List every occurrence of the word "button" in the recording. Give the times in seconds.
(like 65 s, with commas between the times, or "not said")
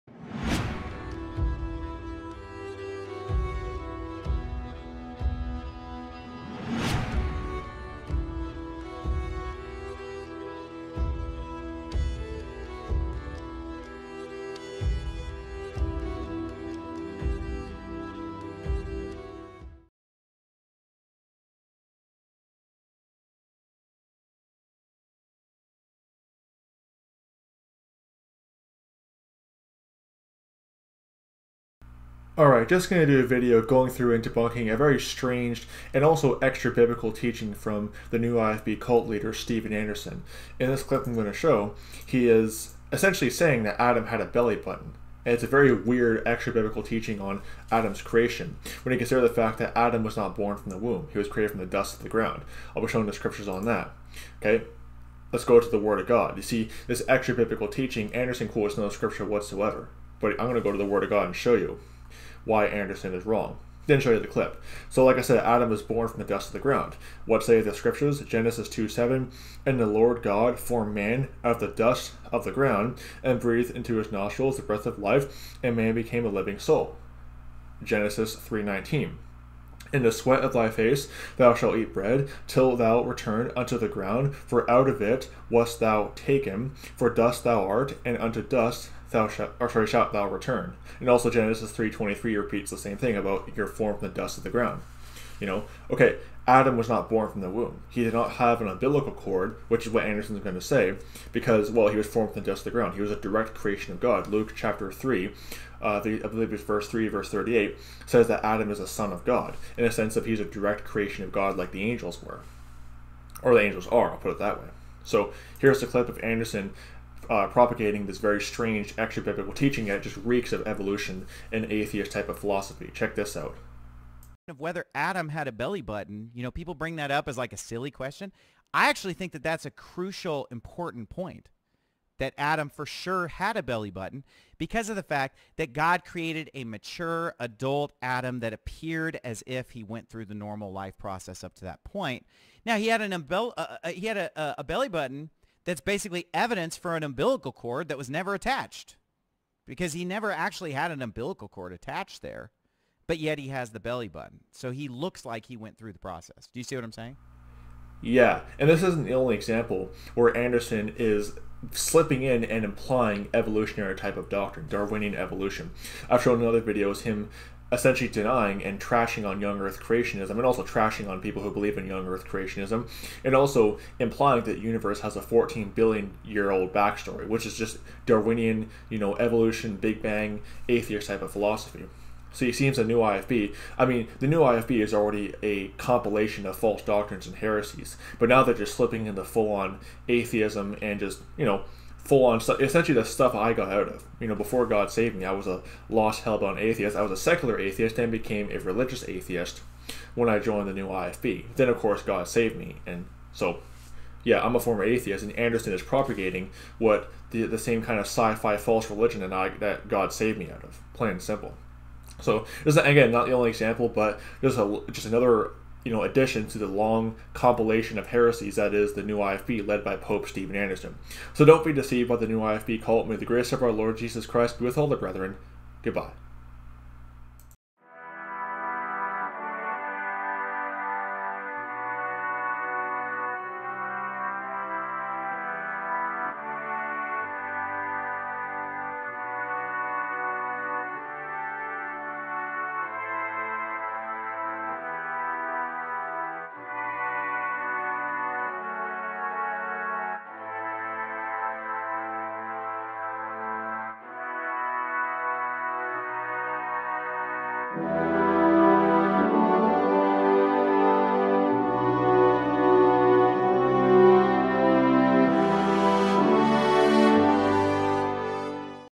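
44 s, 125 s, 133 s, 144 s, 154 s.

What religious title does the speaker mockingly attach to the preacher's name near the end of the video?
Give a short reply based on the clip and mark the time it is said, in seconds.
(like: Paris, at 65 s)
Pope, at 219 s.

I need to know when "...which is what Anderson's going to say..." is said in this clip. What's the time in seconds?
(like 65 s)
99 s.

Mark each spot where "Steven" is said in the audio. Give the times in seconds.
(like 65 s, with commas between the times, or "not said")
39 s, 220 s.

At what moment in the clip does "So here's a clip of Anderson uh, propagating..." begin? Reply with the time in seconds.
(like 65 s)
115 s.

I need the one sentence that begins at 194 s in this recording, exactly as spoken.
You know, before God saved me, I was a lost, hellbound atheist.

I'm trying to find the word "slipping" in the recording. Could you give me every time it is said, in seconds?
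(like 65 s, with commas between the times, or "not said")
161 s, 188 s.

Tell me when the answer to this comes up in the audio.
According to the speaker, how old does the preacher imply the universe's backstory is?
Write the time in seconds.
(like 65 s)
175 s.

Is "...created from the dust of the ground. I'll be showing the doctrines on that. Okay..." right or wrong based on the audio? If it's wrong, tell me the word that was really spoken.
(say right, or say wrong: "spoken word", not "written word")
wrong: "scriptures", not "doctrines".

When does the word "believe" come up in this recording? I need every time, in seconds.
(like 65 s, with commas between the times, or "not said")
106 s, 171 s.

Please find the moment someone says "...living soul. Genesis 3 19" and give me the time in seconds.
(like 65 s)
76 s.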